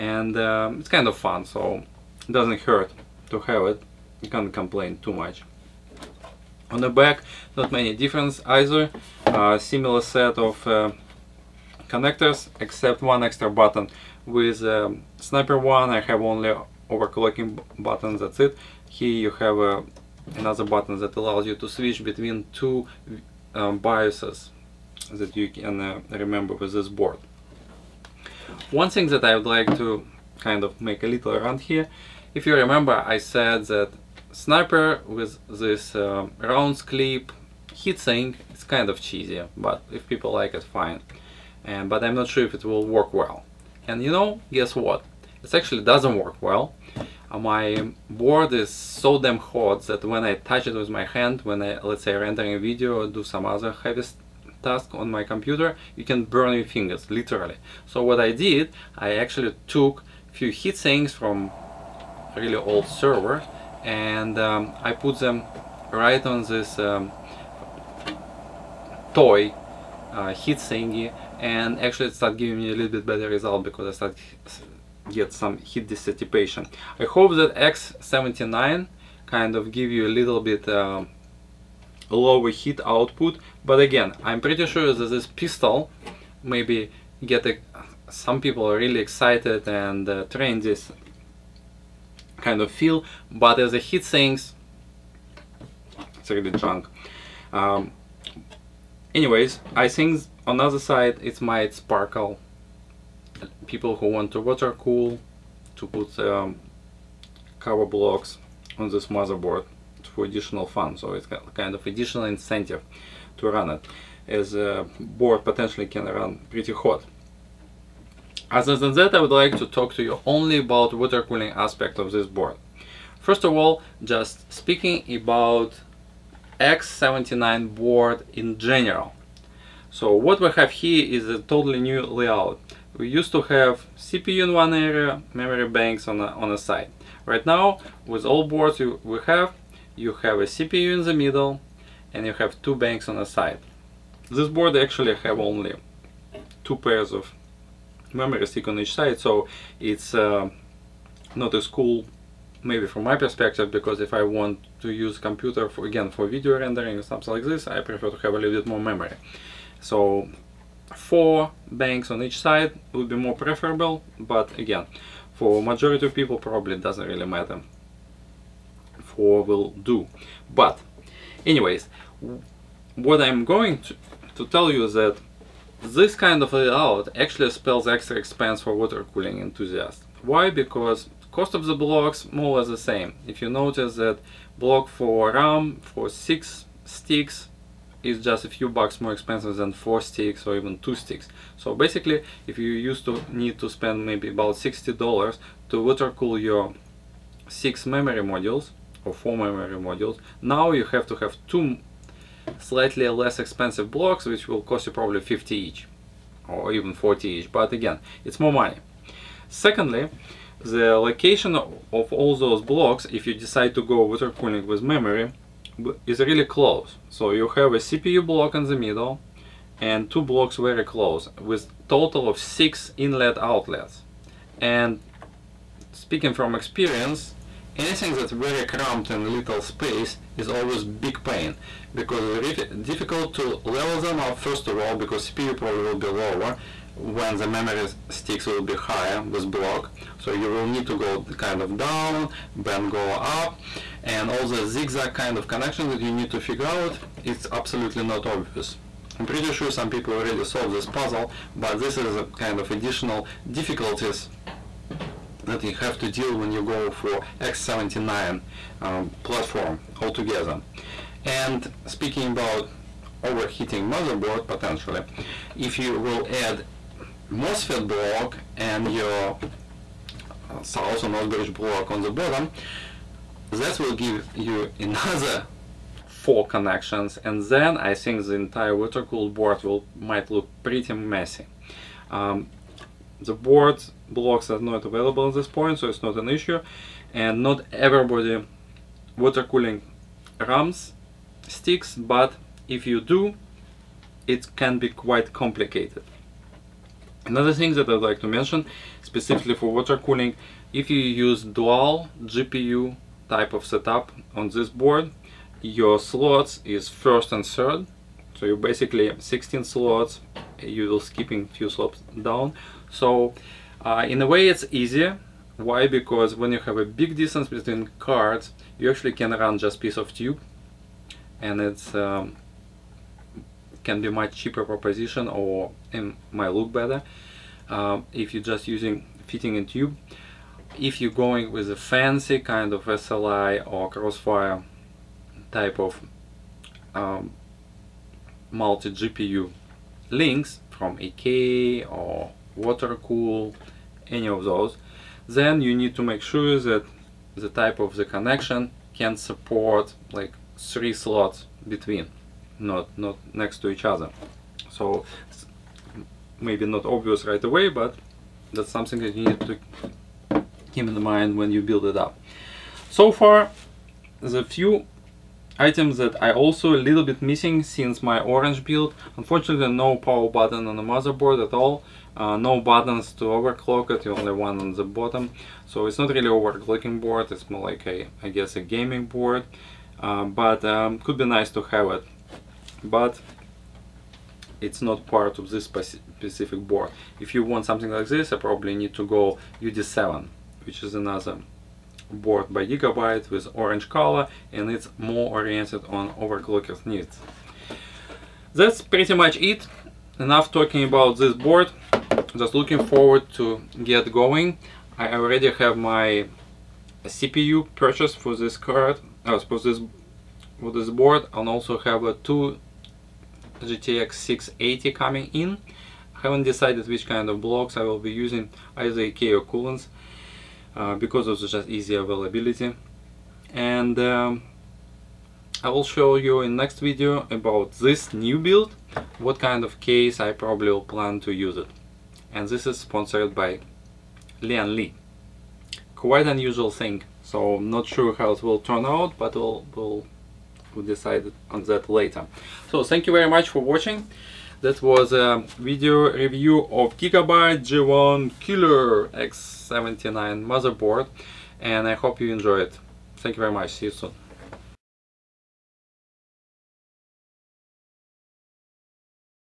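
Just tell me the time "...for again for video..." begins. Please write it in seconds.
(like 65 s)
155 s.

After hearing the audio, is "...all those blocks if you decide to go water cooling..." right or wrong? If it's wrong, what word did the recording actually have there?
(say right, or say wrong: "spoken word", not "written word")
right.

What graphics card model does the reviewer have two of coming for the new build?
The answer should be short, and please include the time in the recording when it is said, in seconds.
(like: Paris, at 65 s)
GTX 680, at 413 s.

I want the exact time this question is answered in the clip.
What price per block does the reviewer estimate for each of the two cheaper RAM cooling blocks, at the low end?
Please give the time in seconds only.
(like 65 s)
206 s.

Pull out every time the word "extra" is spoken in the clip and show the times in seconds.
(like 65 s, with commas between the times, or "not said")
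13 s, 177 s.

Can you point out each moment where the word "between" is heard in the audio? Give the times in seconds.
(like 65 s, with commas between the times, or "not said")
22 s, 317 s, 351 s.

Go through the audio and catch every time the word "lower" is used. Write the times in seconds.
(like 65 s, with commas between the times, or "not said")
82 s, 236 s.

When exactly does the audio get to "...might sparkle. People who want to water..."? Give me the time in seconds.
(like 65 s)
101 s.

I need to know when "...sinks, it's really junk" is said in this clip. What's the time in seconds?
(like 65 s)
94 s.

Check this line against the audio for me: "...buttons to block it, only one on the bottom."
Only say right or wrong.
wrong.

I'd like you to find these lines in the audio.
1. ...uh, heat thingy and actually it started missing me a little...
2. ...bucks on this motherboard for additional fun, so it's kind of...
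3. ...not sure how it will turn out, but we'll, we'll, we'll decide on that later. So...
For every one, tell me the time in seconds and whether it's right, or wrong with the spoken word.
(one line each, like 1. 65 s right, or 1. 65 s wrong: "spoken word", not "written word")
1. 70 s wrong: "giving", not "missing"
2. 107 s wrong: "blocks", not "bucks"
3. 437 s right.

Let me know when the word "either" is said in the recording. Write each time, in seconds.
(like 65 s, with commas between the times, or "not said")
8 s, 418 s.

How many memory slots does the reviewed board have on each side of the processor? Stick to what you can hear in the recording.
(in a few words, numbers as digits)
2 pairs.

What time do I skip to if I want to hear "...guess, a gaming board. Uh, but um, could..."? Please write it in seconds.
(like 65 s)
378 s.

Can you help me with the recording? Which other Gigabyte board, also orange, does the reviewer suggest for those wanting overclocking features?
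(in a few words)
UD7.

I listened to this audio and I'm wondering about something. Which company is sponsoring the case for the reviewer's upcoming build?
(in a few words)
Lian Li.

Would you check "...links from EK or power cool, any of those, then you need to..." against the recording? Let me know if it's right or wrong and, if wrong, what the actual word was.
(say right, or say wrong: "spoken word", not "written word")
wrong: "water", not "power".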